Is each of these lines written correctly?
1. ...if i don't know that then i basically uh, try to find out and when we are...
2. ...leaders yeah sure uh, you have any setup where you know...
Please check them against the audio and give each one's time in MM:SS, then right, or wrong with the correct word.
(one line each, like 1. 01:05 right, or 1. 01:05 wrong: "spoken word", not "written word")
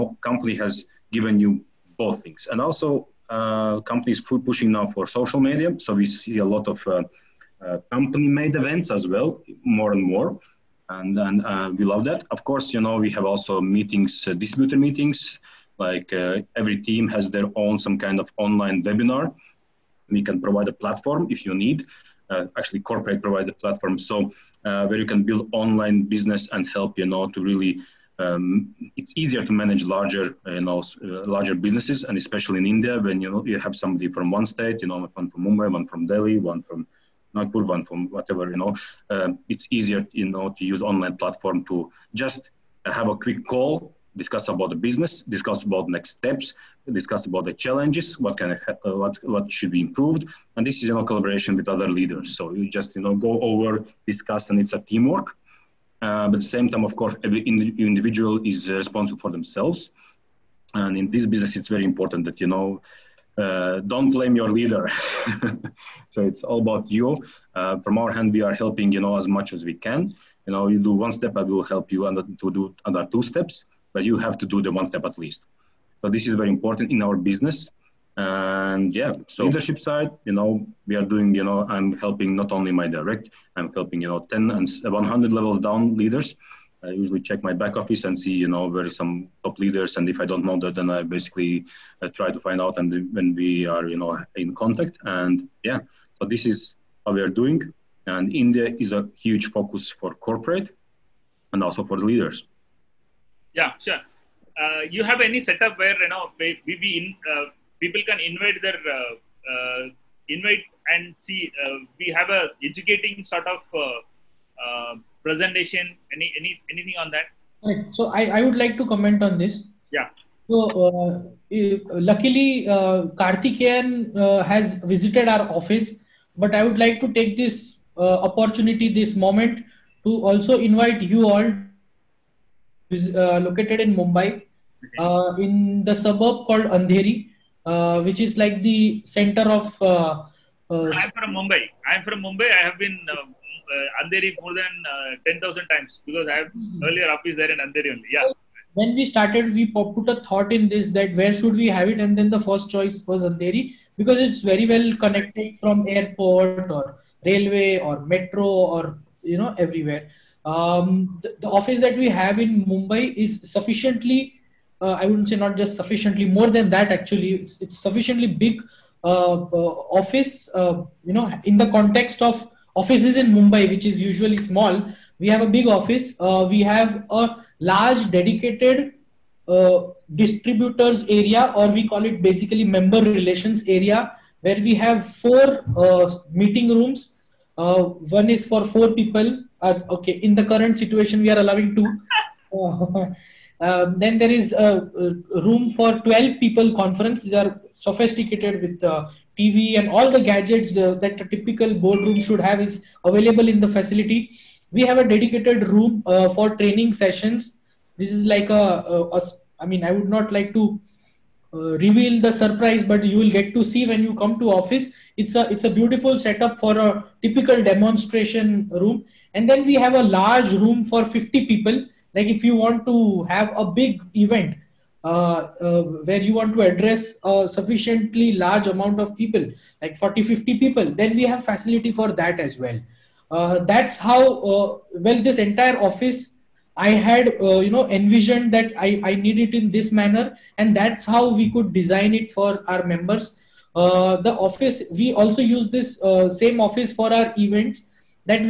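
1. 01:30 right
2. 01:42 right.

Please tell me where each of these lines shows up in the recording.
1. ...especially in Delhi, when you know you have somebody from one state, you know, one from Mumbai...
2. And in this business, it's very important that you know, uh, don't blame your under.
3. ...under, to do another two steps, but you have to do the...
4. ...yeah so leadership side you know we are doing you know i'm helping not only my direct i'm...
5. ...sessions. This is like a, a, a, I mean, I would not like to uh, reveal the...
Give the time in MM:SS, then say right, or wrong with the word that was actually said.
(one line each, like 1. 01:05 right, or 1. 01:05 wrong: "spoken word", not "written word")
1. 00:32 wrong: "India", not "Delhi"
2. 01:00 wrong: "leader", not "under"
3. 01:12 right
4. 01:18 right
5. 03:26 right.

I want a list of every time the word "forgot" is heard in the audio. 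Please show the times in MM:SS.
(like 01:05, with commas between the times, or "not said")
not said.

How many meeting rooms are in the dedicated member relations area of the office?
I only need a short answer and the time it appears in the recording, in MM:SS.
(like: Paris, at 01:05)
4, at 03:05.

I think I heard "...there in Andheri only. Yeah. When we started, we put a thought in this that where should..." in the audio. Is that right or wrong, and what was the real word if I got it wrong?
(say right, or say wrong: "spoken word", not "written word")
right.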